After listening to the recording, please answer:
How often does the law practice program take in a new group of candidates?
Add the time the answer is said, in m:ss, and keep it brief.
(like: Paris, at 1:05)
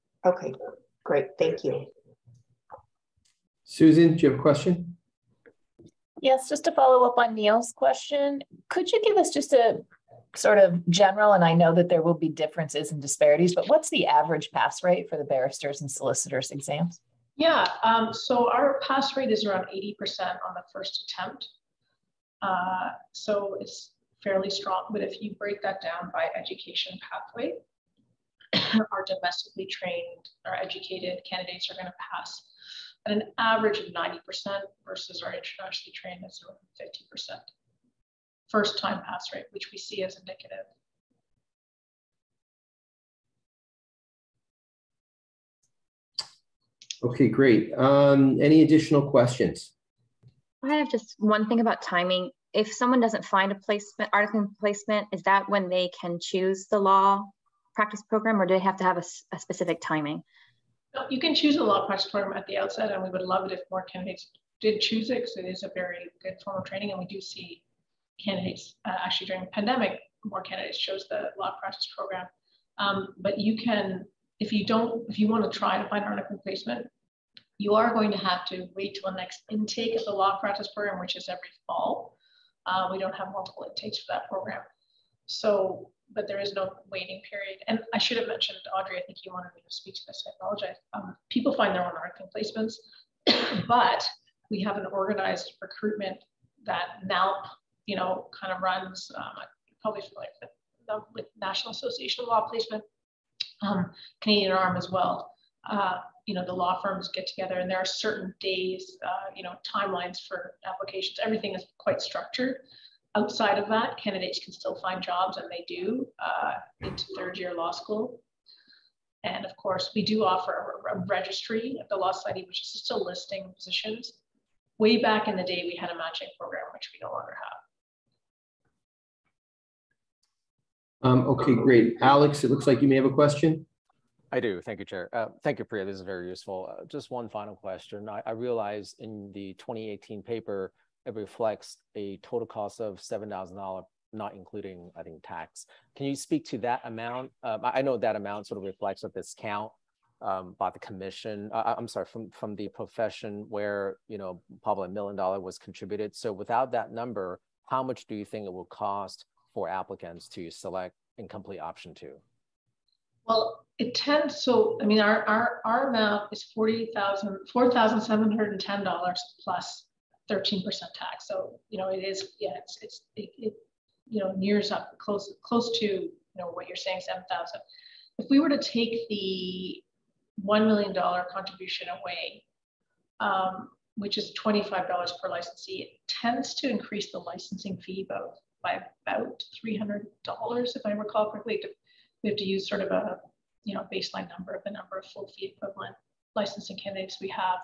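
every fall, at 1:21.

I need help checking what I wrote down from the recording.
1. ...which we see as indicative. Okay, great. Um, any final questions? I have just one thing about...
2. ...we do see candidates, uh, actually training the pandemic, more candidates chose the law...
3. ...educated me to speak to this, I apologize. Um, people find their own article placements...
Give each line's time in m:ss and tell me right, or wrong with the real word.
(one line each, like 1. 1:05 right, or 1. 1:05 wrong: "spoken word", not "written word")
1. 0:39 wrong: "additional", not "final"
2. 1:06 wrong: "during", not "training"
3. 1:29 wrong: "wanted", not "educated".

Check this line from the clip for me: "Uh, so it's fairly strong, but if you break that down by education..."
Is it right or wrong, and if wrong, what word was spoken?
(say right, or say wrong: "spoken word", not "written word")
right.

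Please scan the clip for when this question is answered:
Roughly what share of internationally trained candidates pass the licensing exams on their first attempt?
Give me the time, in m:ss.
0:36.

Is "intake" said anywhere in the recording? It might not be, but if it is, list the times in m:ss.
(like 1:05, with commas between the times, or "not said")
1:19, 1:23.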